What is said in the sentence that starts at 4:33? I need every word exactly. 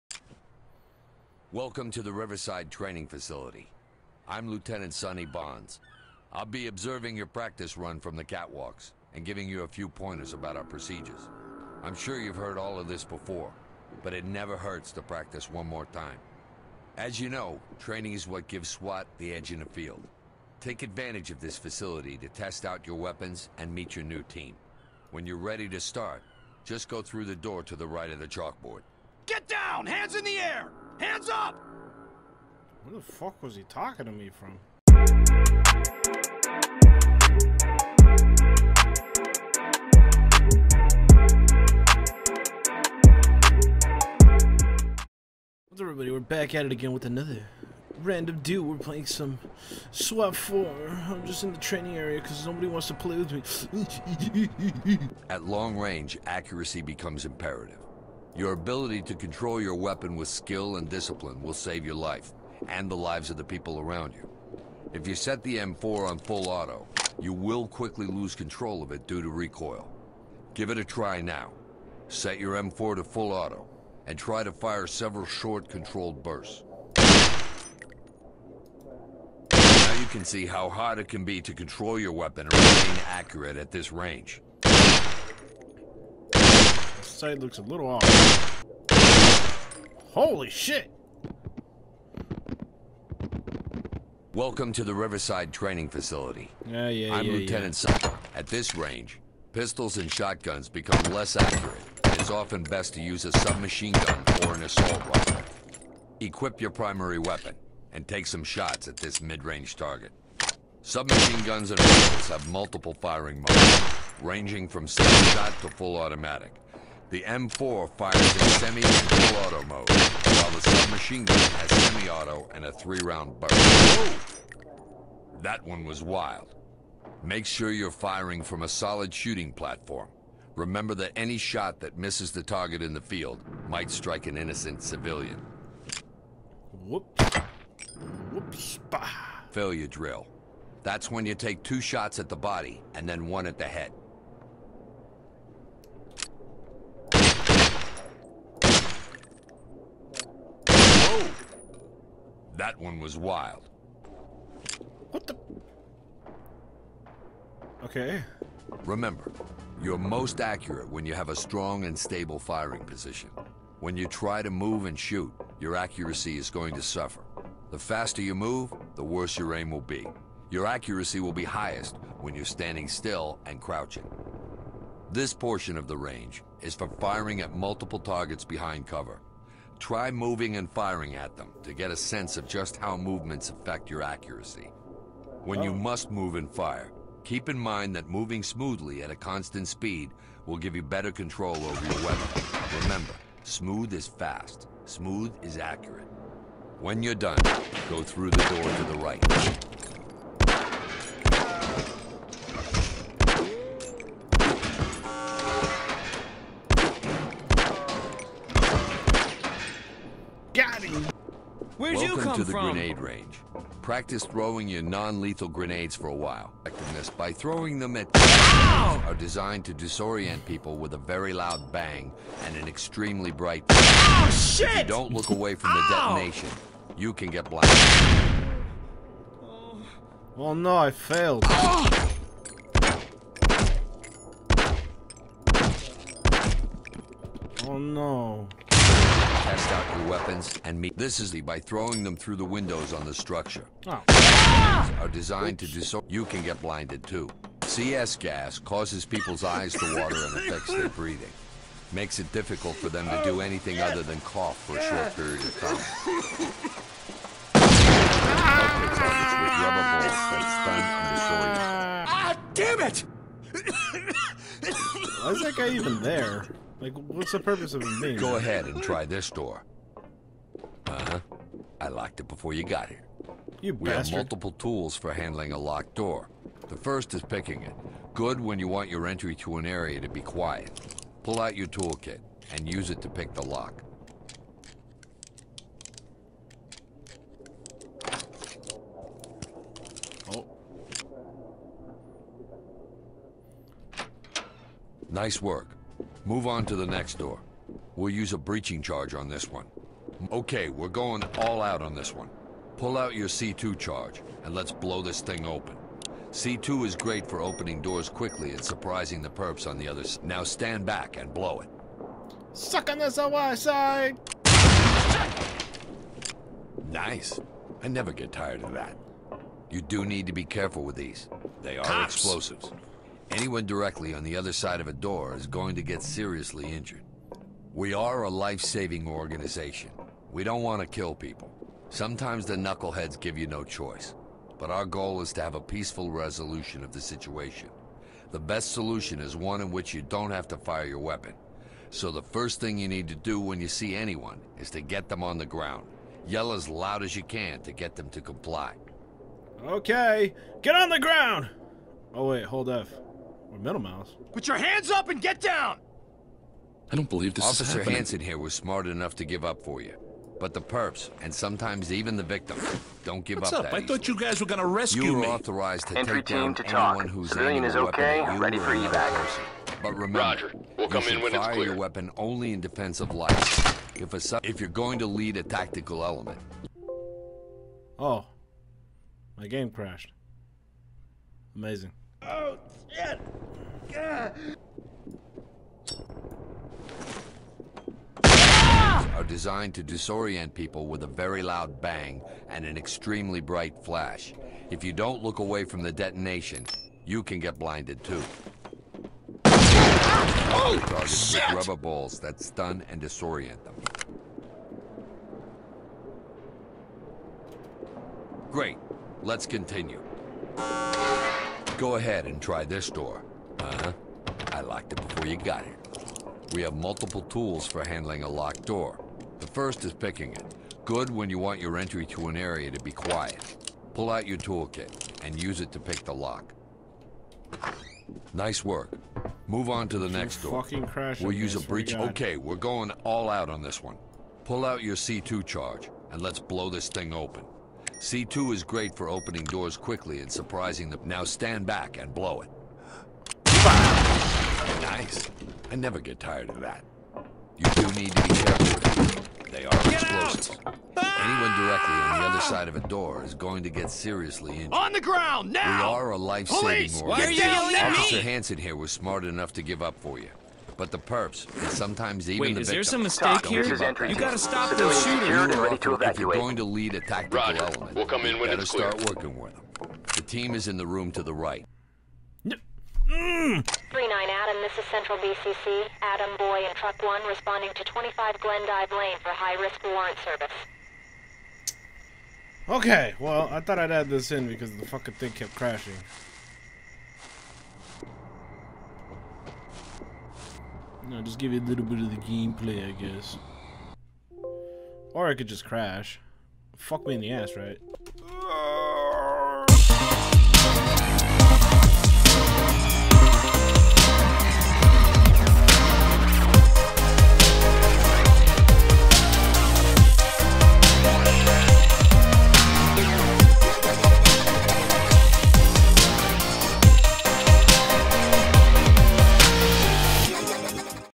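You we have multiple tools for handling a locked door.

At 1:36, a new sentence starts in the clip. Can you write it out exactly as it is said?
Yeah, yeah, I'm yeah, Lieutenant yeah.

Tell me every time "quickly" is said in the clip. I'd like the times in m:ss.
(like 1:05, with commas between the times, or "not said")
1:07, 5:08, 7:19.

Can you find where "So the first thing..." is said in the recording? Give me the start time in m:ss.
5:41.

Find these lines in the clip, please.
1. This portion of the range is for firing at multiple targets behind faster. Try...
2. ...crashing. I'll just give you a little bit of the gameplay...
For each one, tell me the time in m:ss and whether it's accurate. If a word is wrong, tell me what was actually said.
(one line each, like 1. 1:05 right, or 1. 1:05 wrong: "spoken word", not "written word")
1. 2:55 wrong: "cover", not "faster"
2. 8:05 right.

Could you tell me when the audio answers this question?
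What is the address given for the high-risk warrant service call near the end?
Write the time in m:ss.
7:57.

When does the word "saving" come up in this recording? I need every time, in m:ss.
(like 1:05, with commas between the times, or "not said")
5:28, 7:36.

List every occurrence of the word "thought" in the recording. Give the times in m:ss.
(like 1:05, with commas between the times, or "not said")
6:03, 8:03.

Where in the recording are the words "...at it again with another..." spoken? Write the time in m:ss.
0:46.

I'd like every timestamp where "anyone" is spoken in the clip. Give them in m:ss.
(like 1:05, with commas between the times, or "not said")
5:23, 5:43, 6:06, 7:30.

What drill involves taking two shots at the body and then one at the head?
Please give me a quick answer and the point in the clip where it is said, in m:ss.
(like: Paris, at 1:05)
Failure drill, at 2:19.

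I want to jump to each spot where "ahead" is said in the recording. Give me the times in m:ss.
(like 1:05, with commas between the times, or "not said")
4:28, 6:51.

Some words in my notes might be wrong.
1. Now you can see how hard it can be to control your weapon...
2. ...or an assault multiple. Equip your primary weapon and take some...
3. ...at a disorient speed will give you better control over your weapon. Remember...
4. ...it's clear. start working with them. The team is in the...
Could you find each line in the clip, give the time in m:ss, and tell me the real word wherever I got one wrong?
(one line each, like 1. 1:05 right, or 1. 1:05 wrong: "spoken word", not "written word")
1. 1:19 right
2. 1:44 wrong: "rifle", not "multiple"
3. 3:09 wrong: "constant", not "disorient"
4. 7:48 right.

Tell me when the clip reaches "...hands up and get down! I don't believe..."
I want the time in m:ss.
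5:54.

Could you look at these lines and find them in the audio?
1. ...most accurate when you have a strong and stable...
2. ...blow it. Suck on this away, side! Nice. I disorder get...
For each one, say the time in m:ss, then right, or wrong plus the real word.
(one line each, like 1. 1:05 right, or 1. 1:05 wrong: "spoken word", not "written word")
1. 2:39 right
2. 5:11 wrong: "never", not "disorder".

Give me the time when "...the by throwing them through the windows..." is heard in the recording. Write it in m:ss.
4:01.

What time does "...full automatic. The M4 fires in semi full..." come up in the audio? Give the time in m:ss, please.
1:55.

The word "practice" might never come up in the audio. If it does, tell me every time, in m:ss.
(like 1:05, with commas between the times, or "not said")
0:07, 0:15, 3:33.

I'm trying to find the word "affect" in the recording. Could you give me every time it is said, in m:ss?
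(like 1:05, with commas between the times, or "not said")
3:03, 4:10.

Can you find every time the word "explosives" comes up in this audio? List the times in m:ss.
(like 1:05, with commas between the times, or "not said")
5:22, 7:30.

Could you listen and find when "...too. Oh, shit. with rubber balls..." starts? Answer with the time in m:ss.
6:38.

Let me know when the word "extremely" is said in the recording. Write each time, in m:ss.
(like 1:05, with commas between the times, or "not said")
3:42, 6:32.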